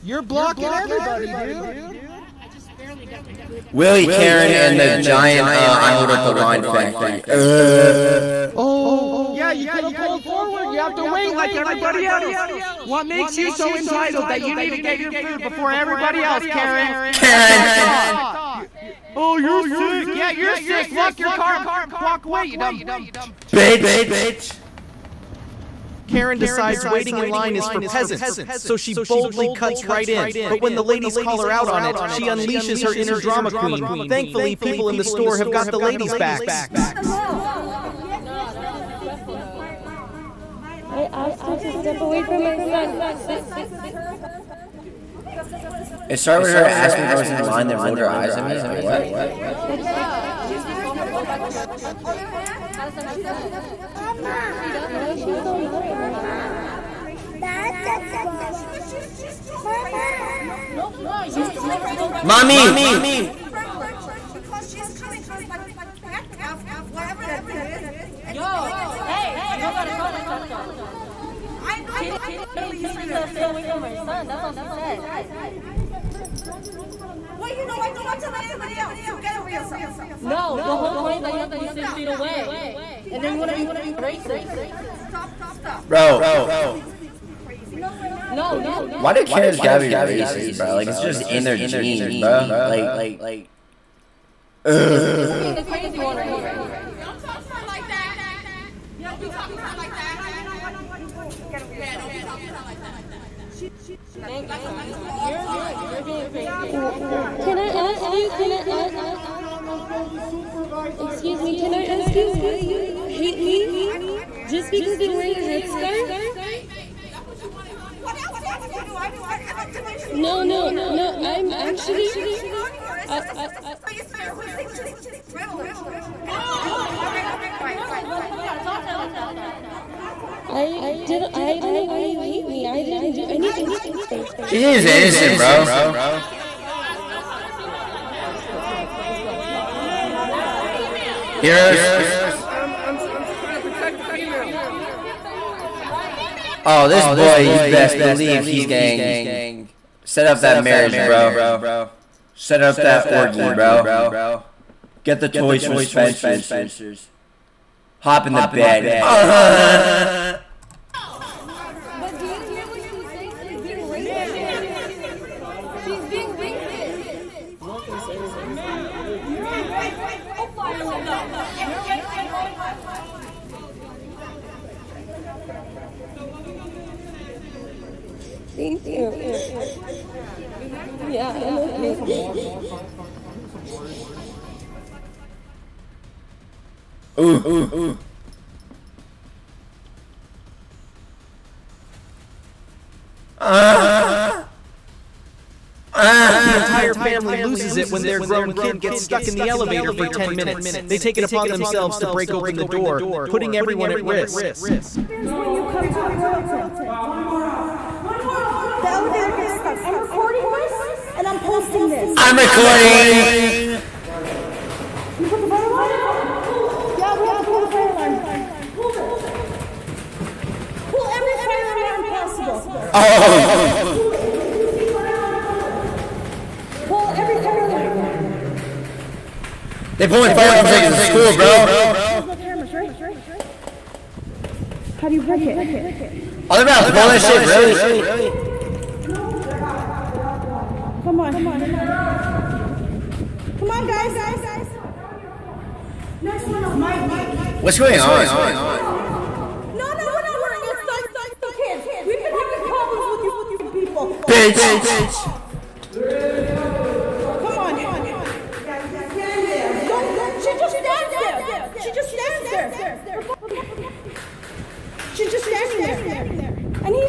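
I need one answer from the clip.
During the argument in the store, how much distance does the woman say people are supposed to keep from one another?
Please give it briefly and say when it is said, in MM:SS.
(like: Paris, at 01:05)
6 feet, at 01:21.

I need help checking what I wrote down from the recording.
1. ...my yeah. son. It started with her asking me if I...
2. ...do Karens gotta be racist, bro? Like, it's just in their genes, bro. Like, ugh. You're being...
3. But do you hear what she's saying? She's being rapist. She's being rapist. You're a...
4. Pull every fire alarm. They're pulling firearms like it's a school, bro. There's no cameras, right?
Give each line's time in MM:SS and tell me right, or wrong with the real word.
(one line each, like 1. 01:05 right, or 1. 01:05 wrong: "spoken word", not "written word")
1. 00:42 right
2. 01:29 right
3. 02:42 right
4. 03:46 right.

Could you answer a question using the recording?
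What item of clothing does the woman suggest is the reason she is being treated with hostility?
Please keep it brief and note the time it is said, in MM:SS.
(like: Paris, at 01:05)
Headscarf, at 01:55.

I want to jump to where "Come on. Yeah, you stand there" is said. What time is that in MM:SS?
04:15.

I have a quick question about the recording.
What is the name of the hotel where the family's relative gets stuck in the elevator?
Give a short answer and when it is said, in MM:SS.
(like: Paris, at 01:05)
Royalton, at 03:26.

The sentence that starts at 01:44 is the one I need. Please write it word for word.
Thank like you, i you're Being, you're being crazy.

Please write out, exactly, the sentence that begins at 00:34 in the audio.
Thankfully, people in the store have got the ladies' backs.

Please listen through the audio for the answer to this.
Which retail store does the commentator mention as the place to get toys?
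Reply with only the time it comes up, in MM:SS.
02:35.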